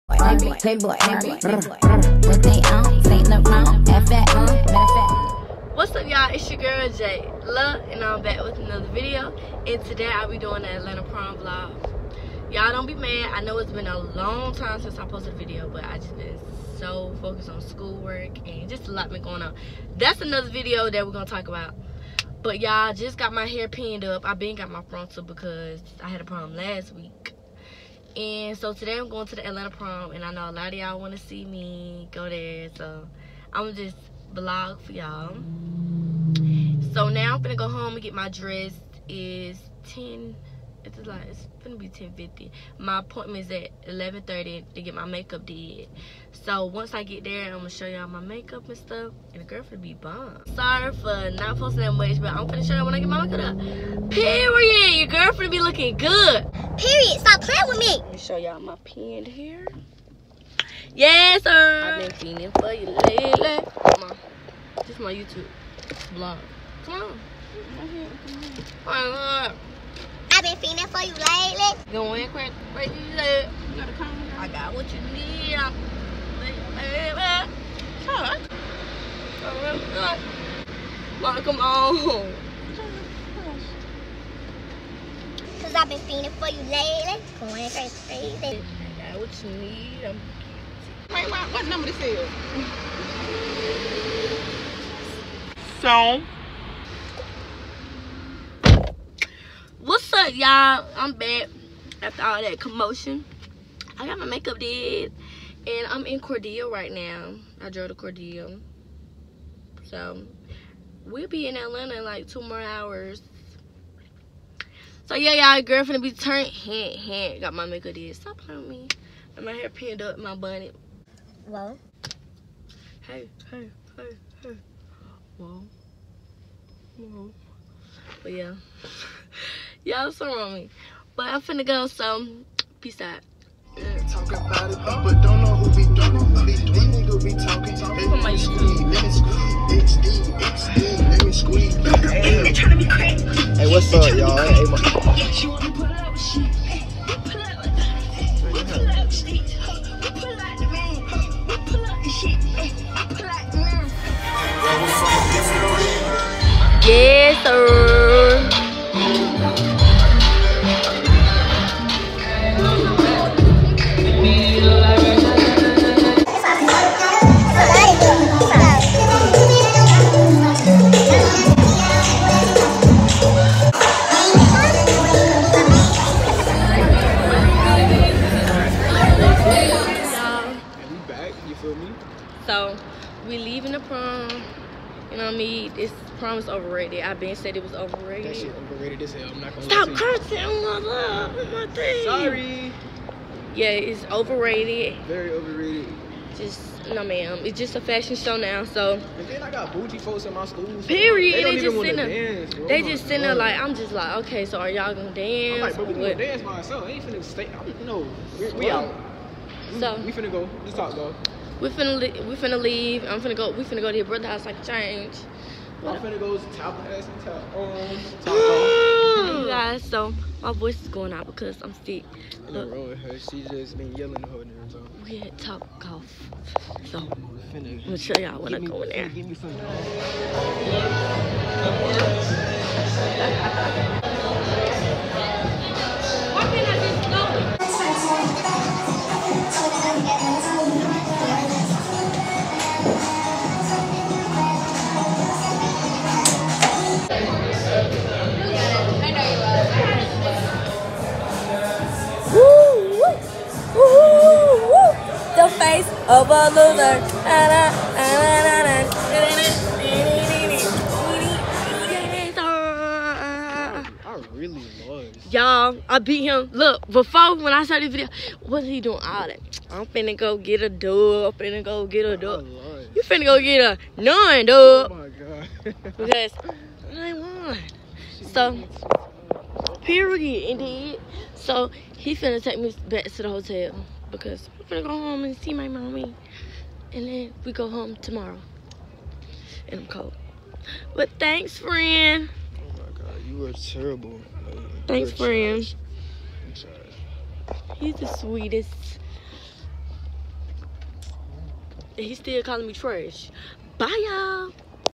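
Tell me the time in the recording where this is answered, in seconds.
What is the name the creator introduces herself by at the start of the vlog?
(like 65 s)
6 s.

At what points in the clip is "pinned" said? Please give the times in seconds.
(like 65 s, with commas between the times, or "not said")
23 s, 119 s.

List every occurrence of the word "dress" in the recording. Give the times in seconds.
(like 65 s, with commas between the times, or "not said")
38 s.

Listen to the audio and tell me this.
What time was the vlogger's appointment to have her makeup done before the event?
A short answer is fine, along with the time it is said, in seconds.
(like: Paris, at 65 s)
11:30, at 43 s.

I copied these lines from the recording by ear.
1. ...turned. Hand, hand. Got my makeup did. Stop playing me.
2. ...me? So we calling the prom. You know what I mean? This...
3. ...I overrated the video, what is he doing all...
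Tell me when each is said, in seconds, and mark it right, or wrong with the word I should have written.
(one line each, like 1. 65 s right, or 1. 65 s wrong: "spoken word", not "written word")
1. 116 s right
2. 181 s wrong: "leaving", not "calling"
3. 267 s wrong: "started", not "overrated".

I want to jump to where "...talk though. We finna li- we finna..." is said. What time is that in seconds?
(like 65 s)
210 s.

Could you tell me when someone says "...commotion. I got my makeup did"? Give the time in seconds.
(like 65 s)
102 s.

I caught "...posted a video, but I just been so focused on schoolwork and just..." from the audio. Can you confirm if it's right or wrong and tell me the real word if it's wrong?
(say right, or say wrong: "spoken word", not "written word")
right.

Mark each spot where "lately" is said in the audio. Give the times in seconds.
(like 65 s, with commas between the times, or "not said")
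63 s, 71 s, 86 s.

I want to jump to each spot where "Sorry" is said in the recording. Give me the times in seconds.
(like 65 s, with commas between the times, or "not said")
50 s, 192 s.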